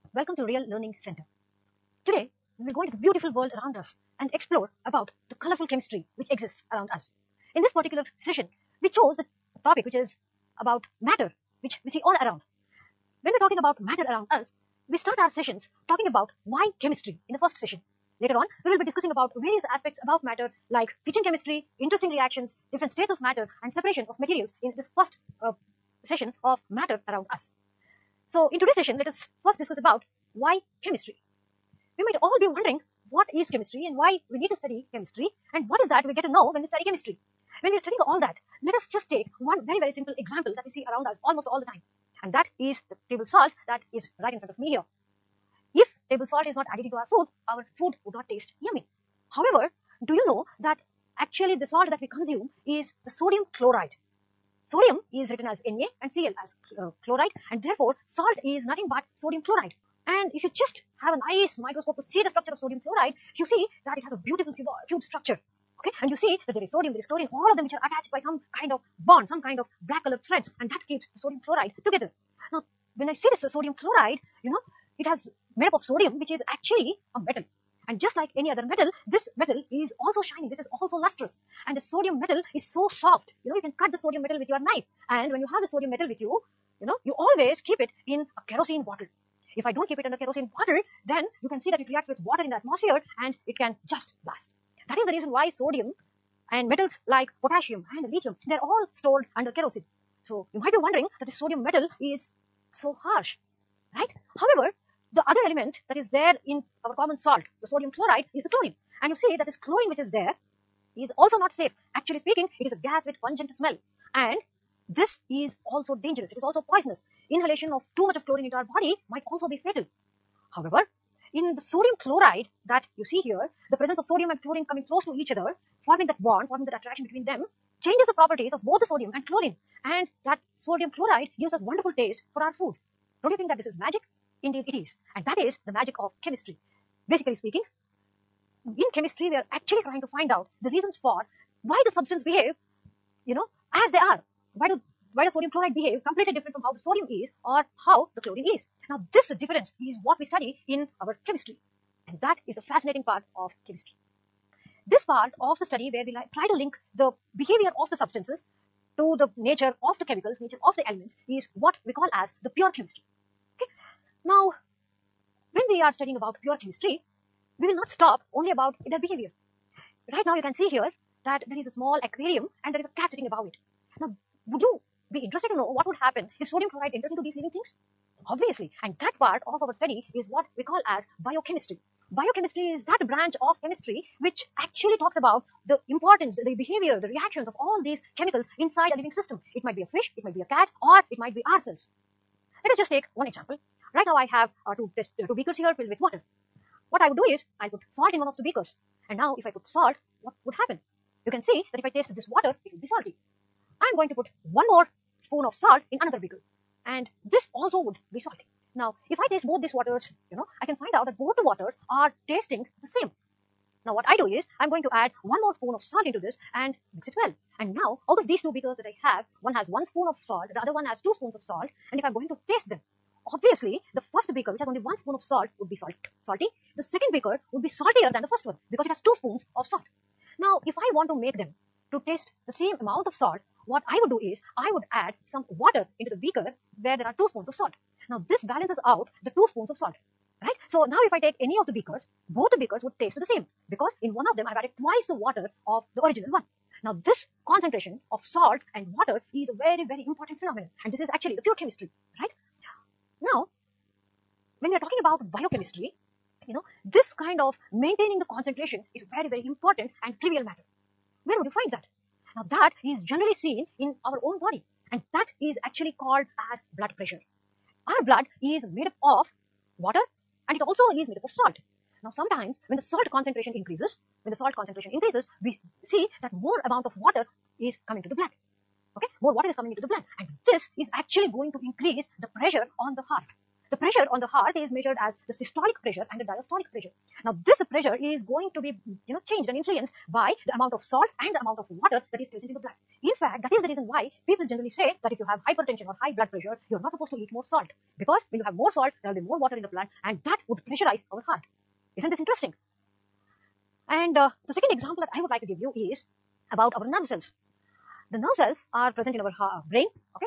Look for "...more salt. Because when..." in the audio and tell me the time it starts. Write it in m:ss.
4:57.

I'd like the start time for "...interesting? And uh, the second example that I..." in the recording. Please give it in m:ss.
5:02.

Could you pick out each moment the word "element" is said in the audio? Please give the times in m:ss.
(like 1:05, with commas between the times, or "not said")
1:45, 2:40.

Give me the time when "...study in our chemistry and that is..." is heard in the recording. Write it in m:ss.
2:30.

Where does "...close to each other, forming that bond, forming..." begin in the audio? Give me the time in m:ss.
2:04.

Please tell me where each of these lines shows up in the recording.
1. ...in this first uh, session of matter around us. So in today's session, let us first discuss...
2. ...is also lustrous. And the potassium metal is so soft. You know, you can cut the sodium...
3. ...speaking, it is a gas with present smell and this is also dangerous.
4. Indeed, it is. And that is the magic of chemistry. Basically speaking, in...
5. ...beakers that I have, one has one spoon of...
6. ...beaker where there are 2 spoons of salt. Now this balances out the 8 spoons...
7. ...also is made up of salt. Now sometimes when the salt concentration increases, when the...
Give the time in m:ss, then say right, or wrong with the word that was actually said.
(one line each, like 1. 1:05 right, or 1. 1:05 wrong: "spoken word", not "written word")
1. 0:24 right
2. 1:20 wrong: "sodium", not "potassium"
3. 1:52 wrong: "pungent", not "present"
4. 2:14 right
5. 3:38 right
6. 3:56 wrong: "2", not "8"
7. 4:30 right.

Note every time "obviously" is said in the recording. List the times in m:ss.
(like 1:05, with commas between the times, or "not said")
2:58, 3:43.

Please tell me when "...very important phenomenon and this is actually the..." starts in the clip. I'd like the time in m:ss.
4:09.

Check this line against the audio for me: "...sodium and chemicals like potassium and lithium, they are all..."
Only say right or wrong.
wrong.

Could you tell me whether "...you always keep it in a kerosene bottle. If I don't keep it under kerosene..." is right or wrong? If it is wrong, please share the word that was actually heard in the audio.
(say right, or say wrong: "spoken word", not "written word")
right.